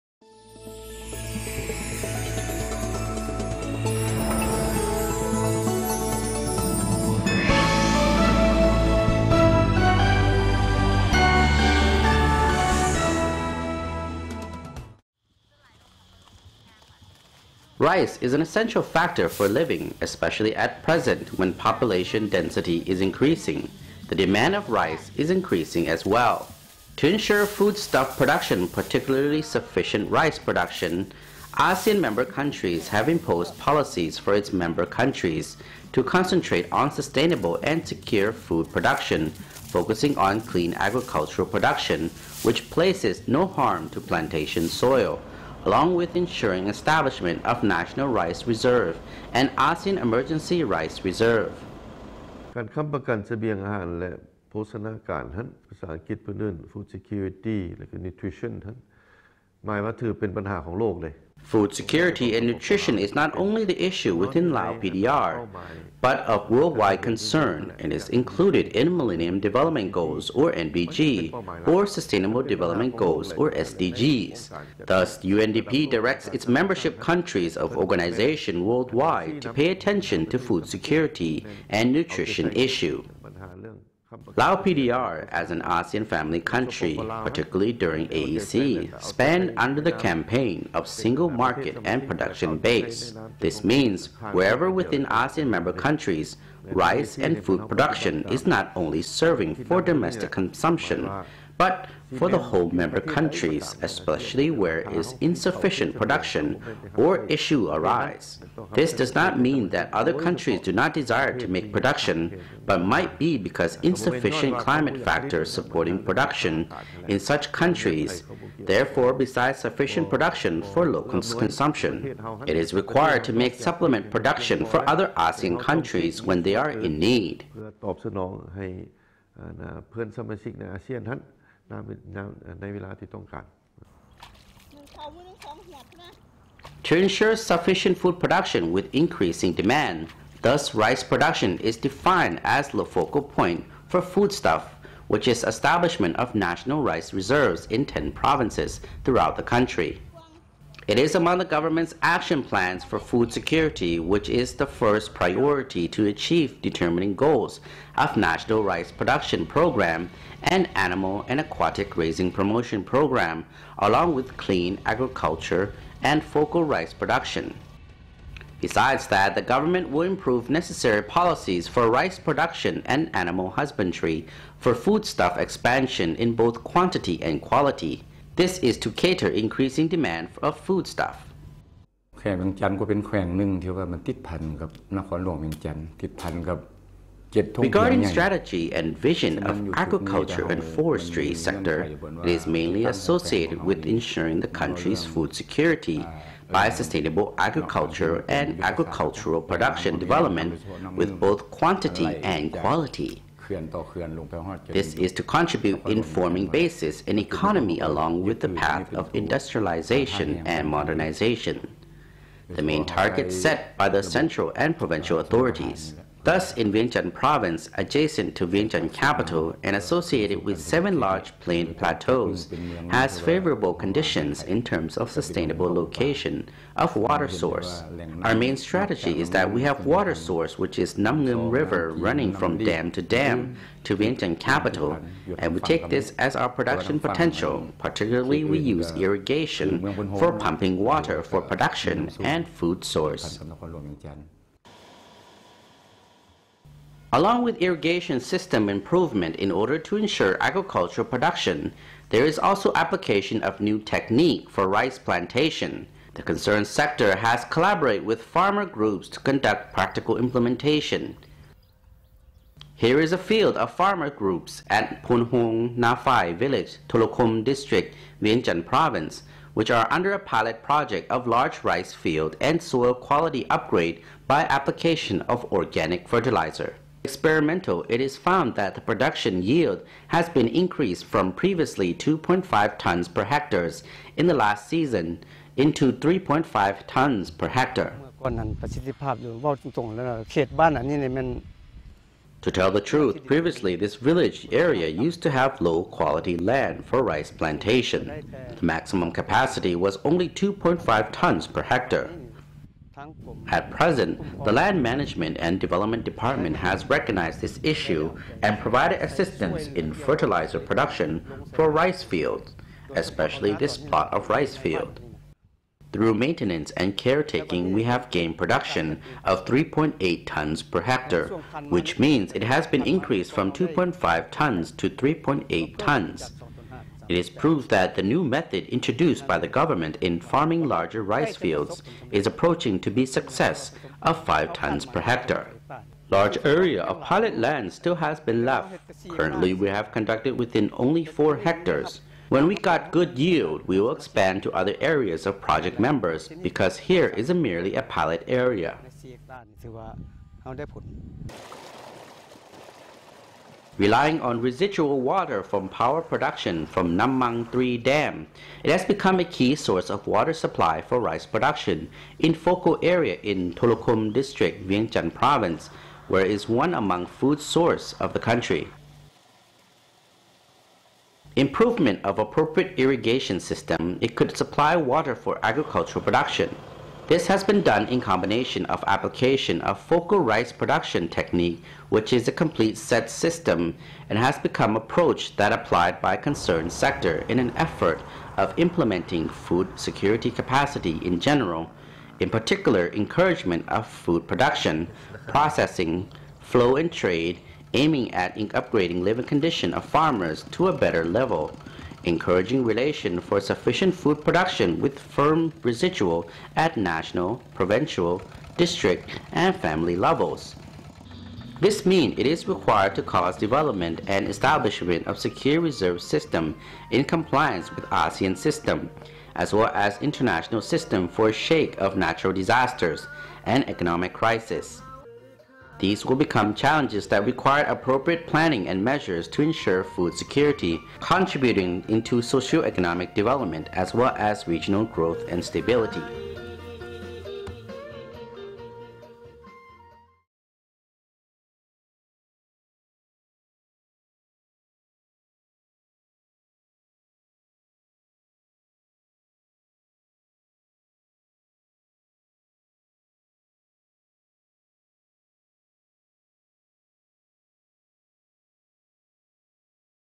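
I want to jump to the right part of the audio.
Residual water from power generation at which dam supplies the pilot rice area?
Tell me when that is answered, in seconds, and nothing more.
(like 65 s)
356 s.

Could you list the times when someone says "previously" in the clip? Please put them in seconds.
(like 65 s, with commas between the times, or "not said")
281 s, 293 s.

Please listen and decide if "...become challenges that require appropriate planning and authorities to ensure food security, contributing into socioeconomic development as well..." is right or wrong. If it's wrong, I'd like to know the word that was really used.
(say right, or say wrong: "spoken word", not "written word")
wrong: "measures", not "authorities".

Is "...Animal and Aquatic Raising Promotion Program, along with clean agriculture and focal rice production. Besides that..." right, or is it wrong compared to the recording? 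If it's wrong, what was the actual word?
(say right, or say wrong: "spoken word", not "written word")
right.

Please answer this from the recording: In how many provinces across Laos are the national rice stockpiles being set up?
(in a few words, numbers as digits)
10.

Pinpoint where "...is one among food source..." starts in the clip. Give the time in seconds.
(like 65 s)
366 s.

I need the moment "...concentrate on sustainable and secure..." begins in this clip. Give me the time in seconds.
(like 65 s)
36 s.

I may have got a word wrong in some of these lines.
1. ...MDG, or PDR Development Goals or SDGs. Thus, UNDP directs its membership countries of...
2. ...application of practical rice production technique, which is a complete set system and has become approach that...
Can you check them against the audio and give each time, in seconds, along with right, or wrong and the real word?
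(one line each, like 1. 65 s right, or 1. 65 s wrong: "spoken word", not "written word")
1. 70 s wrong: "Sustainable", not "PDR"
2. 378 s wrong: "focal", not "practical".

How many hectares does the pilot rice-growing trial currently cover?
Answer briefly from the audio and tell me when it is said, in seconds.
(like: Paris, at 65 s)
4 hectares, at 341 s.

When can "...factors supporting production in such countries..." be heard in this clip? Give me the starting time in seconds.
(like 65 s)
115 s.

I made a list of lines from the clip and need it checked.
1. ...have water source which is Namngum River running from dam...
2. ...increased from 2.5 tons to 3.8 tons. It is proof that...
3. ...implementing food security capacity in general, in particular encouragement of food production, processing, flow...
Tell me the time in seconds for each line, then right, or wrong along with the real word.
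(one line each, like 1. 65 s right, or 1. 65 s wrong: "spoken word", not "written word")
1. 229 s right
2. 322 s right
3. 388 s right.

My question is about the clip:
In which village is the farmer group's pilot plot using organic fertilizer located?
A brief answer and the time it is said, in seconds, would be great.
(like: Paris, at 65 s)
Punhong Nafai, at 265 s.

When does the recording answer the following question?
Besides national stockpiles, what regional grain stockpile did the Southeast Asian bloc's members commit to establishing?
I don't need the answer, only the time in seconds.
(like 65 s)
49 s.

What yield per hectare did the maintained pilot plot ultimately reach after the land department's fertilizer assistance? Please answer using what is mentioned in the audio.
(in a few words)
3.8 tons per hectare.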